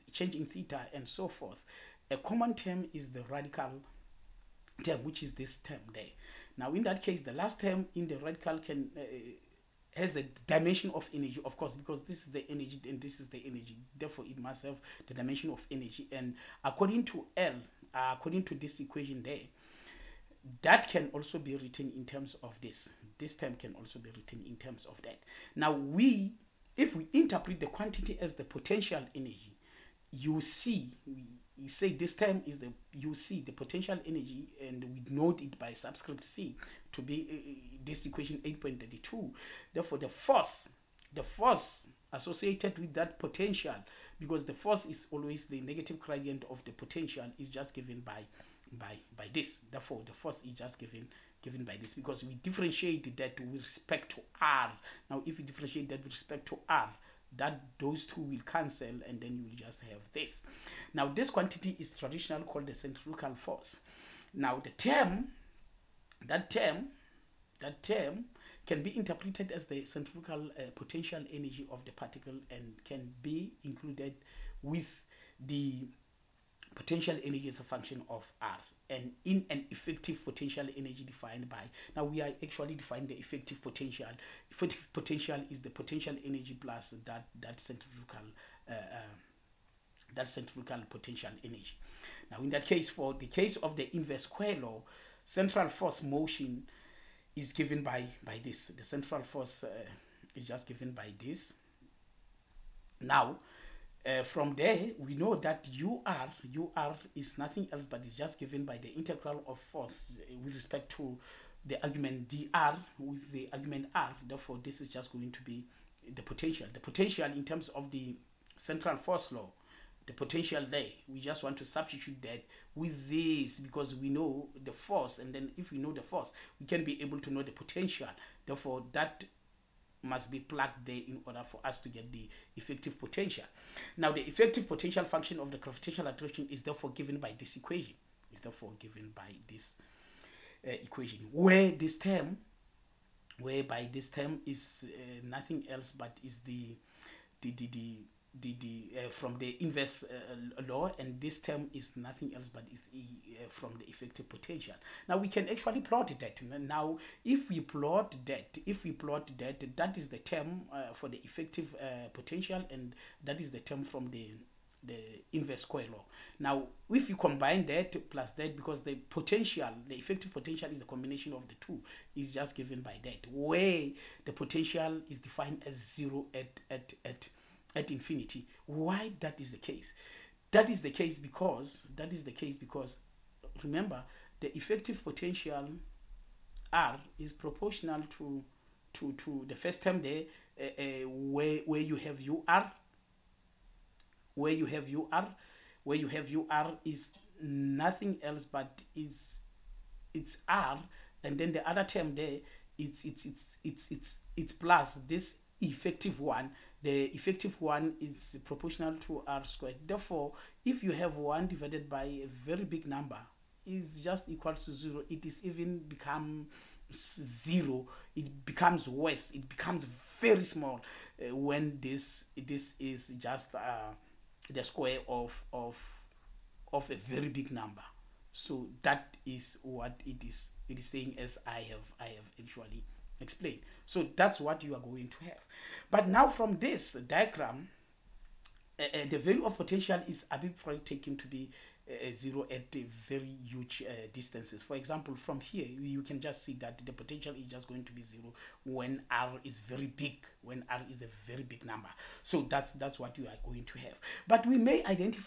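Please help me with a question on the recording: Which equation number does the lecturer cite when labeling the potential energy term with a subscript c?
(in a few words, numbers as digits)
8.32.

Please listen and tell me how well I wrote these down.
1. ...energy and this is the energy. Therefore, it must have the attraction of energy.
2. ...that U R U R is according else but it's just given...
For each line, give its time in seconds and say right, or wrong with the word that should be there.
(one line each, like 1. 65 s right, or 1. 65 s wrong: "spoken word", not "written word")
1. 12 s wrong: "dimension", not "attraction"
2. 105 s wrong: "nothing", not "according".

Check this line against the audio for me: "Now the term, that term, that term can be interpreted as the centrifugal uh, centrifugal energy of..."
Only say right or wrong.
wrong.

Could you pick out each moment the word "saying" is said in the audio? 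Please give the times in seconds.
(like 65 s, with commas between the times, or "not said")
230 s.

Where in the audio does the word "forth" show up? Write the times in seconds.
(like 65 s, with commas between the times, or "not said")
1 s.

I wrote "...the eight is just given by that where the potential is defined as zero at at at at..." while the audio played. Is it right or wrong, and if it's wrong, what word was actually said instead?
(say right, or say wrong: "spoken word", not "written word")
wrong: "two", not "eight".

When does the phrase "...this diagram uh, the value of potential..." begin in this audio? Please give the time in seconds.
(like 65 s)
236 s.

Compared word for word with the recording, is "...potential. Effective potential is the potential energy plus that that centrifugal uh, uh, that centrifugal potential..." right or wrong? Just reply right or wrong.
right.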